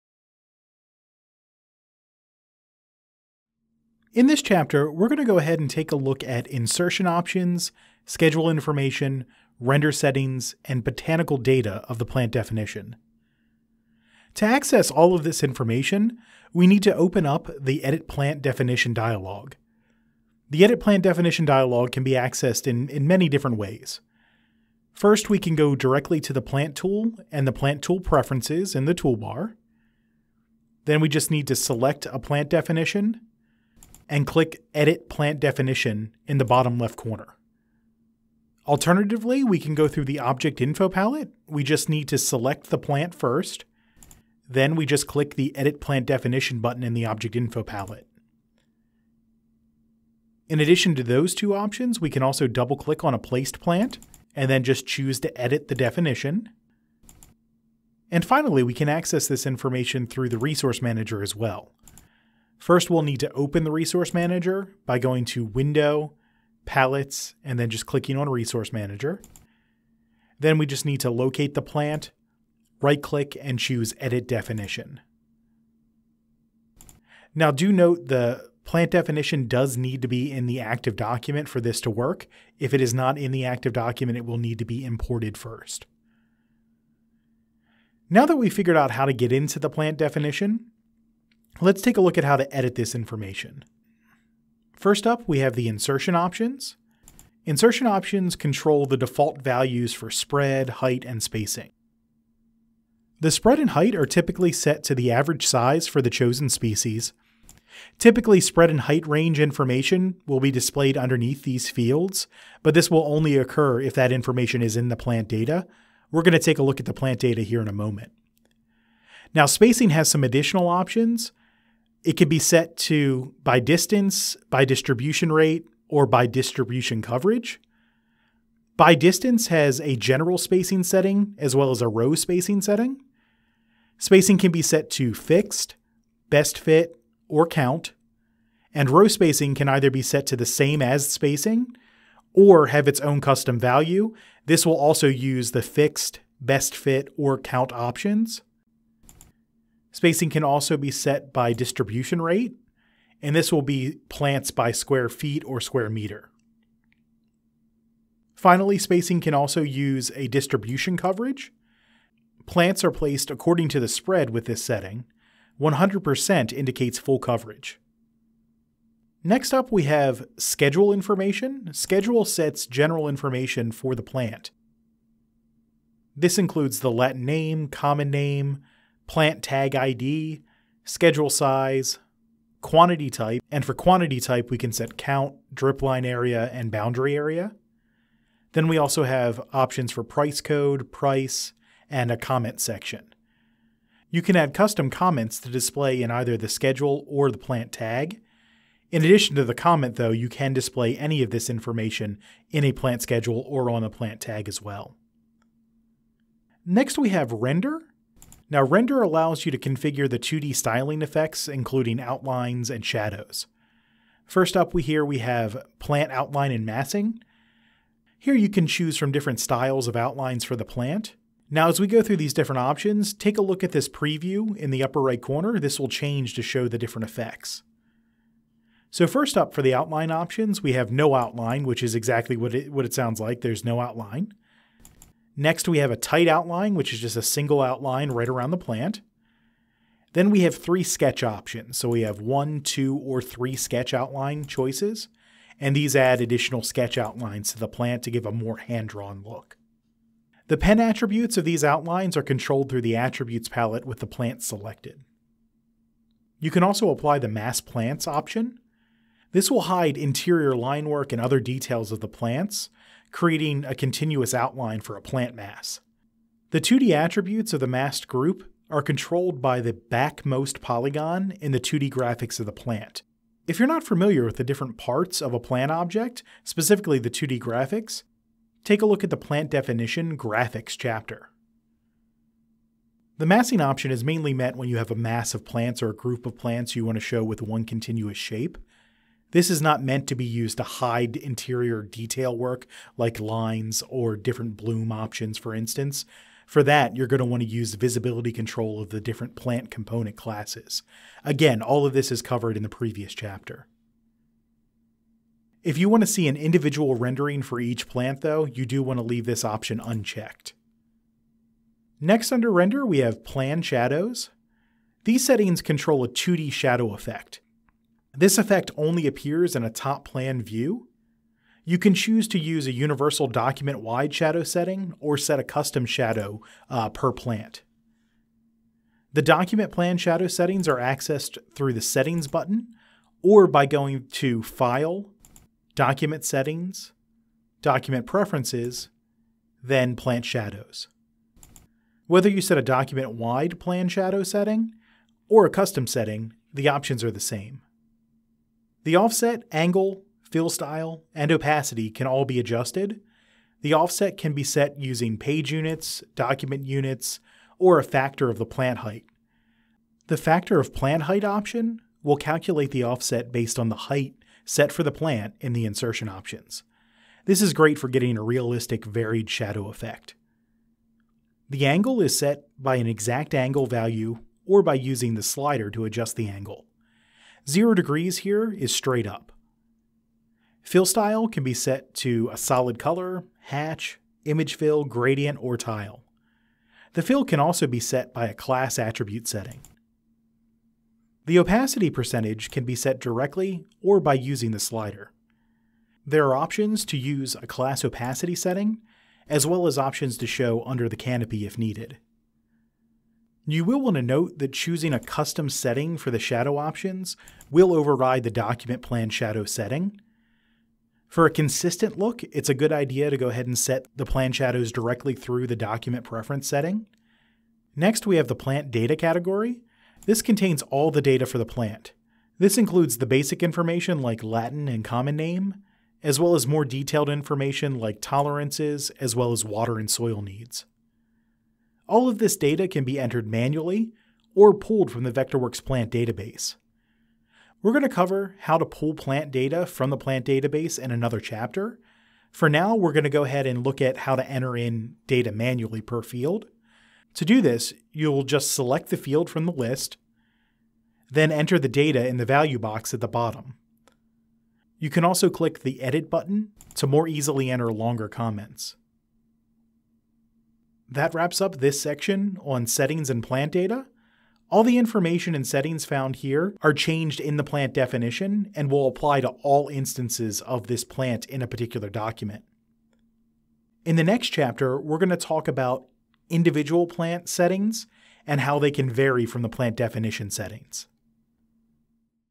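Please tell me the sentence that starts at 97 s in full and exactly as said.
Insertion options control the default values for spread, height, and spacing.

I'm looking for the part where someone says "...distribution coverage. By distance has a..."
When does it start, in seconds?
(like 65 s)
126 s.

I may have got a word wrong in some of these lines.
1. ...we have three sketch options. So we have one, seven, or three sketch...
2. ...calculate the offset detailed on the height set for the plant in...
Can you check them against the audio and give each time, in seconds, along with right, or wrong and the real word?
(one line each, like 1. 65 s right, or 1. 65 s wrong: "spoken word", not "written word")
1. 240 s wrong: "two", not "seven"
2. 362 s wrong: "based", not "detailed".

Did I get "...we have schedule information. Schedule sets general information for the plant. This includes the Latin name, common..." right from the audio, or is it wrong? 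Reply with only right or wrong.
right.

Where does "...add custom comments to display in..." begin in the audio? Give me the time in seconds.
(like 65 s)
194 s.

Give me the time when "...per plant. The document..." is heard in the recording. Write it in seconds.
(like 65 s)
326 s.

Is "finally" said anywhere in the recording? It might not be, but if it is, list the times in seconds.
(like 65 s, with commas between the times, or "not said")
58 s, 158 s.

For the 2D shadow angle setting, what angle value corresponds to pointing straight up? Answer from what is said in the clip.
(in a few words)
0 degrees.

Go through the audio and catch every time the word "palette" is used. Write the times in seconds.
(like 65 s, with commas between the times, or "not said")
40 s, 47 s, 66 s, 253 s.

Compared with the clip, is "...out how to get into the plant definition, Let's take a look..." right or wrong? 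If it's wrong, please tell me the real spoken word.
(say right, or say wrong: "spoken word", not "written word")
right.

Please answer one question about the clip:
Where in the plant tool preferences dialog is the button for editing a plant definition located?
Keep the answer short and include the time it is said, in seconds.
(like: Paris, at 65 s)
Bottom left corner, at 36 s.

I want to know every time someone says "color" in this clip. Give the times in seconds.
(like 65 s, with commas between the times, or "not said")
382 s.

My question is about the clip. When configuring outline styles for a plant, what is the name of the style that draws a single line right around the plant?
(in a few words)
Tight outline.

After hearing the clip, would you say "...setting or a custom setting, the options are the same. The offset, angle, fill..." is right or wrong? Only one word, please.
right.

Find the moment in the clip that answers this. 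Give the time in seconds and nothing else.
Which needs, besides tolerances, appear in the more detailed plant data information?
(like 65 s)
429 s.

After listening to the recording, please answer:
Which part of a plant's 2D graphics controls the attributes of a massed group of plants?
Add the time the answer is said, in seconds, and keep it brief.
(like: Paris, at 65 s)
Backmost polygon, at 269 s.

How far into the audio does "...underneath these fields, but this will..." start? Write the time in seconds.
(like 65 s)
110 s.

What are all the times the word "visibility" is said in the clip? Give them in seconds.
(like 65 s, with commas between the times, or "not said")
297 s.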